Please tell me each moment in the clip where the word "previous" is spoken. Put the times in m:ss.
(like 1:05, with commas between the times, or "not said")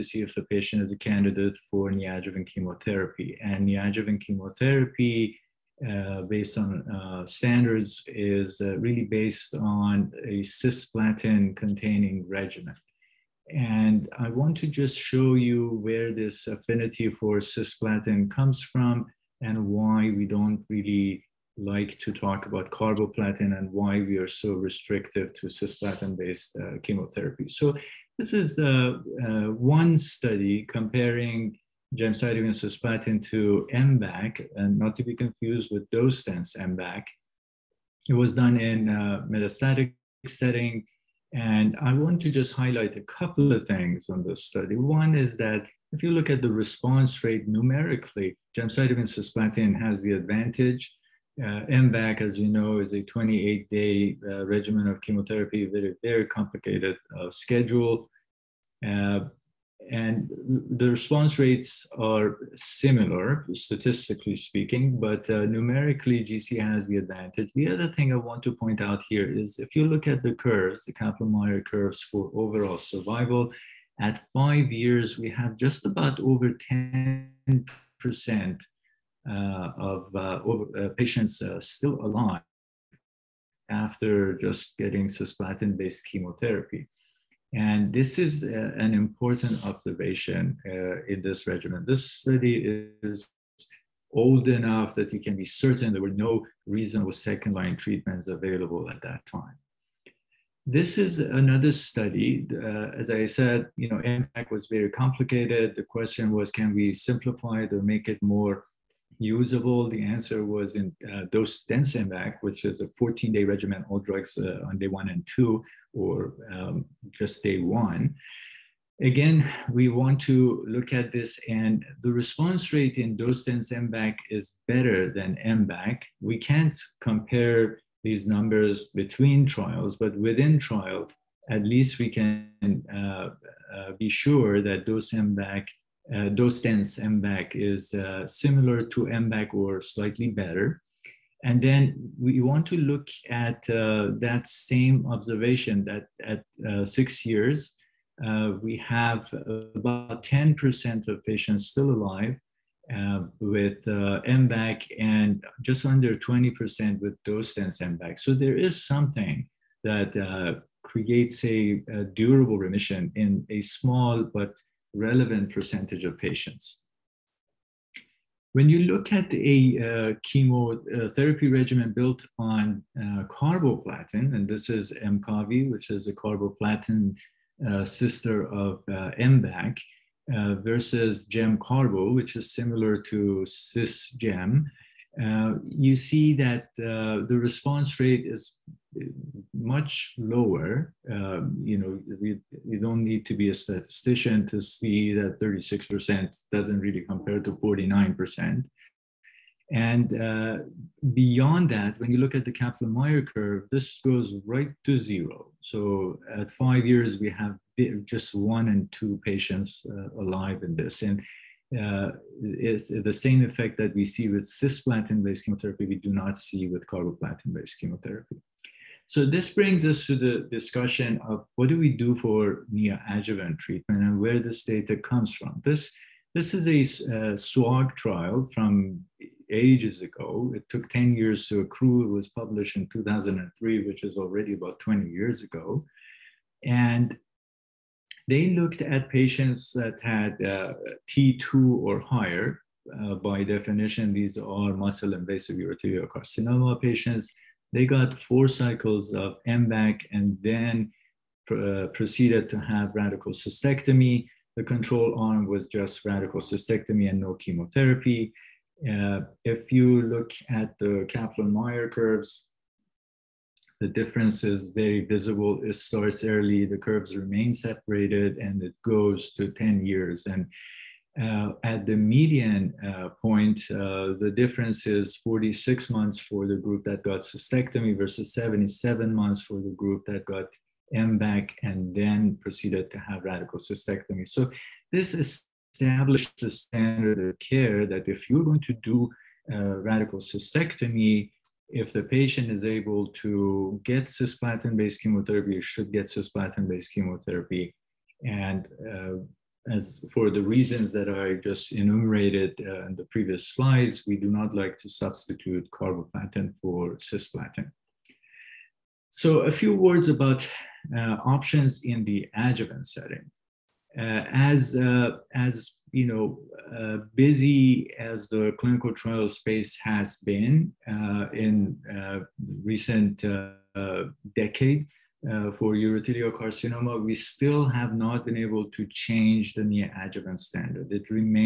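5:03.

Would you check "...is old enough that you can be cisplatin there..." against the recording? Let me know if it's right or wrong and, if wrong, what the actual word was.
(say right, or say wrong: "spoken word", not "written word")
wrong: "certain", not "cisplatin".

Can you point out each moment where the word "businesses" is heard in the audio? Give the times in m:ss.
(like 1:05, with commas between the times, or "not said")
not said.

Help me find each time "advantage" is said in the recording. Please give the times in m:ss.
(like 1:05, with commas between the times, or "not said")
0:50, 1:06.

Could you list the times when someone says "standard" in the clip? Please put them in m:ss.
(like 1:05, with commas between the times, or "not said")
0:07, 4:46, 5:30.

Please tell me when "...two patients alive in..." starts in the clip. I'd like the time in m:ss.
3:28.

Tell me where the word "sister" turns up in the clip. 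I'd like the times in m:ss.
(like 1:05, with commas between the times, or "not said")
2:57.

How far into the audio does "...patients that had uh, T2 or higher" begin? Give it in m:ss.
3:59.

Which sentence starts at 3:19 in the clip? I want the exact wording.
And uh, beyond that, when you look at the Kaplan-Meier curve, this goes right to zero.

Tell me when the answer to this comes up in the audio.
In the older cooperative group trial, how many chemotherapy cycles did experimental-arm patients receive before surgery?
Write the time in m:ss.
4:08.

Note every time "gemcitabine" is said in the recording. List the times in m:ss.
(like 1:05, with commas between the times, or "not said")
0:31, 0:48.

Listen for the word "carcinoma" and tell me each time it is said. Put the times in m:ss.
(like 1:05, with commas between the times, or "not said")
4:06, 5:26.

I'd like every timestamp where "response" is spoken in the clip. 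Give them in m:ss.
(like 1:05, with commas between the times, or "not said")
0:46, 1:00, 2:02, 3:07.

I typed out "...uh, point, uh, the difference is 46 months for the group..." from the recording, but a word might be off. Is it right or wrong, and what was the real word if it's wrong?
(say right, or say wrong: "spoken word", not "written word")
right.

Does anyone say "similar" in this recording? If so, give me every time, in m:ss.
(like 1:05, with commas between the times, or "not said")
1:02, 2:18, 3:02.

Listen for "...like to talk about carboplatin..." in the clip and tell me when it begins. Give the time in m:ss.
0:21.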